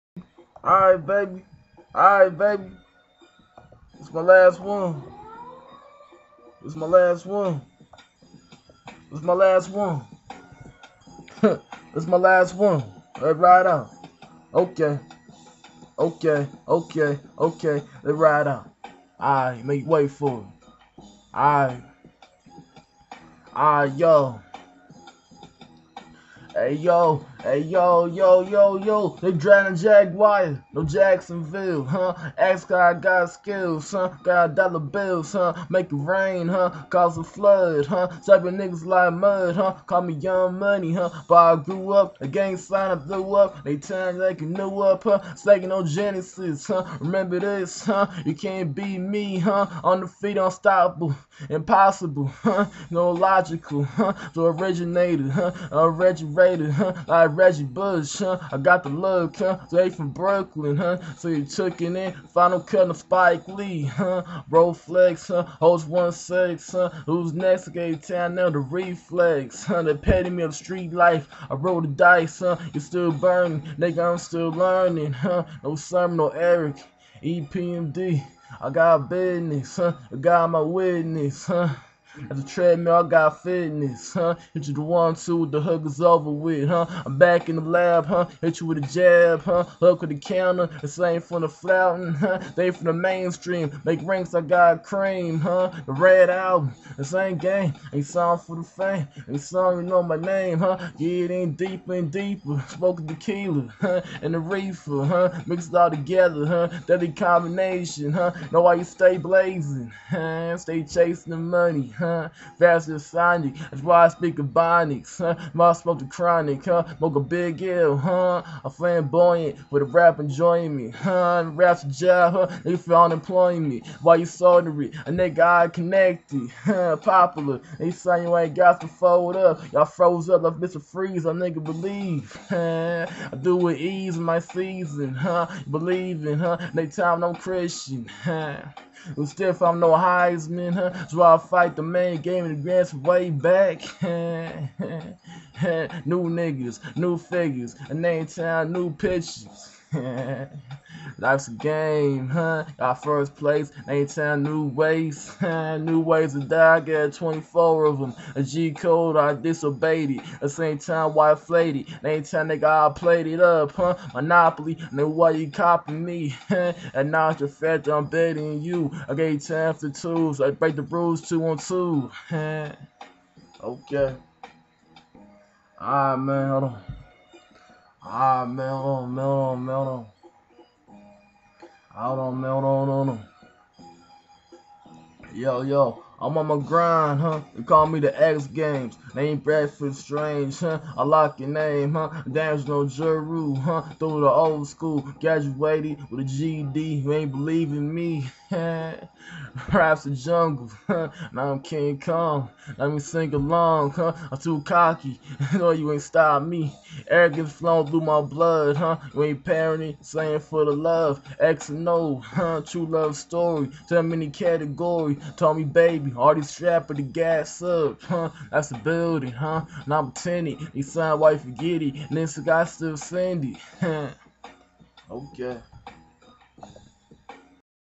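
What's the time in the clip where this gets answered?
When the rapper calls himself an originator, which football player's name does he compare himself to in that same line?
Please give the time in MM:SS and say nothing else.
00:57.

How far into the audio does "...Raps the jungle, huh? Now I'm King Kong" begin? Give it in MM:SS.
03:19.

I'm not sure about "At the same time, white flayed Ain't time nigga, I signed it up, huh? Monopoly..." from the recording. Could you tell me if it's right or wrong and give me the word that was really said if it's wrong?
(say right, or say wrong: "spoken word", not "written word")
wrong: "played", not "signed".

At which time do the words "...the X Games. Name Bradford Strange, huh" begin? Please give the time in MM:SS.
03:07.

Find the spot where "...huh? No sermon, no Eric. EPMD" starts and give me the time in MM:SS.
01:15.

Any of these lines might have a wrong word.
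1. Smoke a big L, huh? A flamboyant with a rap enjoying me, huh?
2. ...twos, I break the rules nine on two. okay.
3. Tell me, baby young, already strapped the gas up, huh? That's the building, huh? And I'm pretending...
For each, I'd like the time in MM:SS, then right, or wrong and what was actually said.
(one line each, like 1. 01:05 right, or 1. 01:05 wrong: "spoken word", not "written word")
1. 01:56 right
2. 02:49 wrong: "two", not "nine"
3. 03:35 wrong: "building", not "young".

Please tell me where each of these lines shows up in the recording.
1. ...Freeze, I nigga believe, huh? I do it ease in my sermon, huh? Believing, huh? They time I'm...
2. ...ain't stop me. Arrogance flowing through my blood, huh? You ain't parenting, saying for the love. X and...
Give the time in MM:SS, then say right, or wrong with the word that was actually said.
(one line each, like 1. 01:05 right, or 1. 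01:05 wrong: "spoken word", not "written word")
1. 02:10 wrong: "season", not "sermon"
2. 03:25 right.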